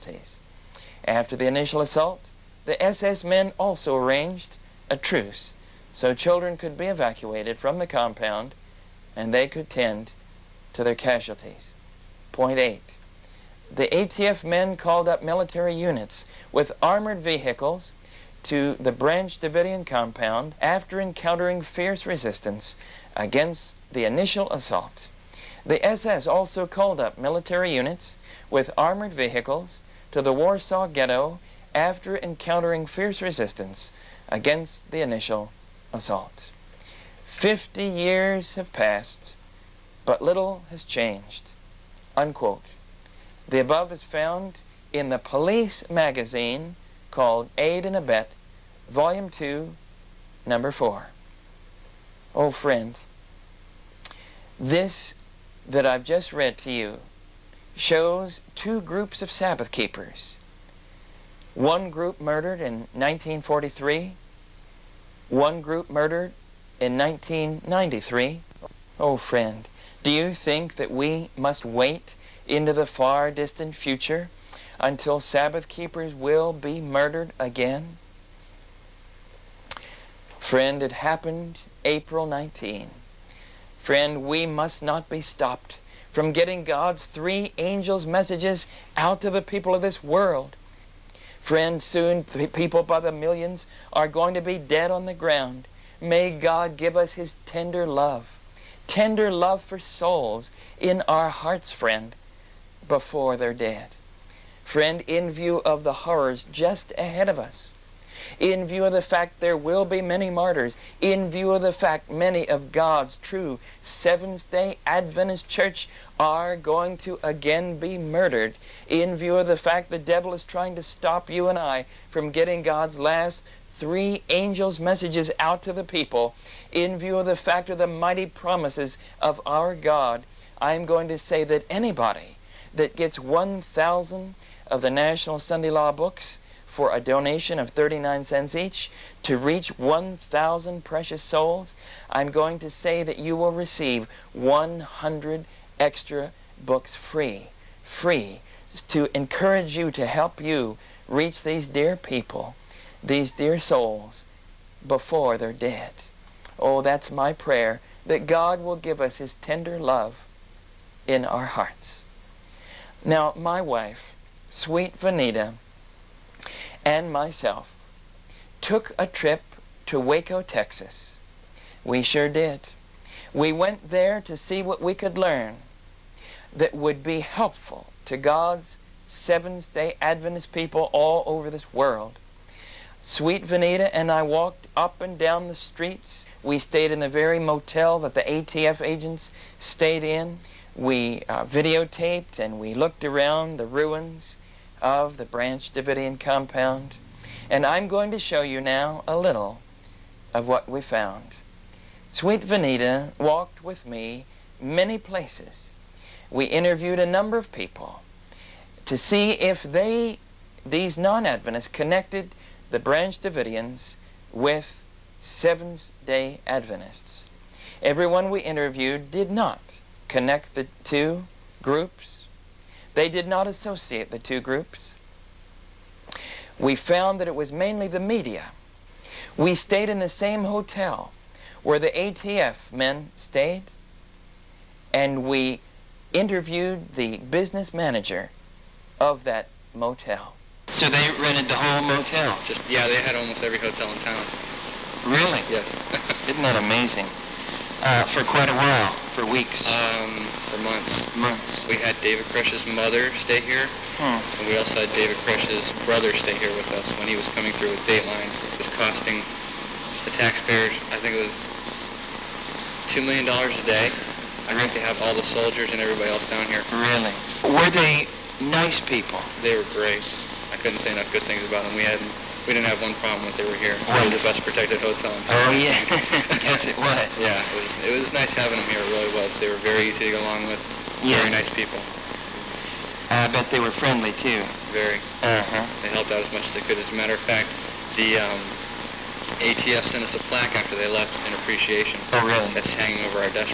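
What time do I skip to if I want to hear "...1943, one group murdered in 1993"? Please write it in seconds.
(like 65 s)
62 s.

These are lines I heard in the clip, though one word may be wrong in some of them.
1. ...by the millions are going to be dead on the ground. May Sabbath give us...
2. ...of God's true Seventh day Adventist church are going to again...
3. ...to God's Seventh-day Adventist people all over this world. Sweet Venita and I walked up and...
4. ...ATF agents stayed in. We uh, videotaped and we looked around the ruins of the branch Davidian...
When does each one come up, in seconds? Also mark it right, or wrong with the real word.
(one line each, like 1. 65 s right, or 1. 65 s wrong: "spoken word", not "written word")
1. 92 s wrong: "God", not "Sabbath"
2. 112 s right
3. 178 s right
4. 188 s right.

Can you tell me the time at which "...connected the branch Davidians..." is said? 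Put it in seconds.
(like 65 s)
211 s.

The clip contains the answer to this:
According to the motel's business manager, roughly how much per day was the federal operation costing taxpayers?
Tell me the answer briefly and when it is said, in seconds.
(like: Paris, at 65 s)
$2 million, at 262 s.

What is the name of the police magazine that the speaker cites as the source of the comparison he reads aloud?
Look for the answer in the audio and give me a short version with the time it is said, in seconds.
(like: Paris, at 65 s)
Aid and Abet, at 47 s.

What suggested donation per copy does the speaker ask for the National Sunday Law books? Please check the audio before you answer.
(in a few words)
39 cents.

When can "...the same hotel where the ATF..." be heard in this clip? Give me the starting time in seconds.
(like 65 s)
229 s.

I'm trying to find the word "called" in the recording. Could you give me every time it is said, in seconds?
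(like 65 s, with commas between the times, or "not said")
14 s, 26 s, 47 s.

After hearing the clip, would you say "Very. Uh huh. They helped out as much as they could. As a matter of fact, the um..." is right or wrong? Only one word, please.
right.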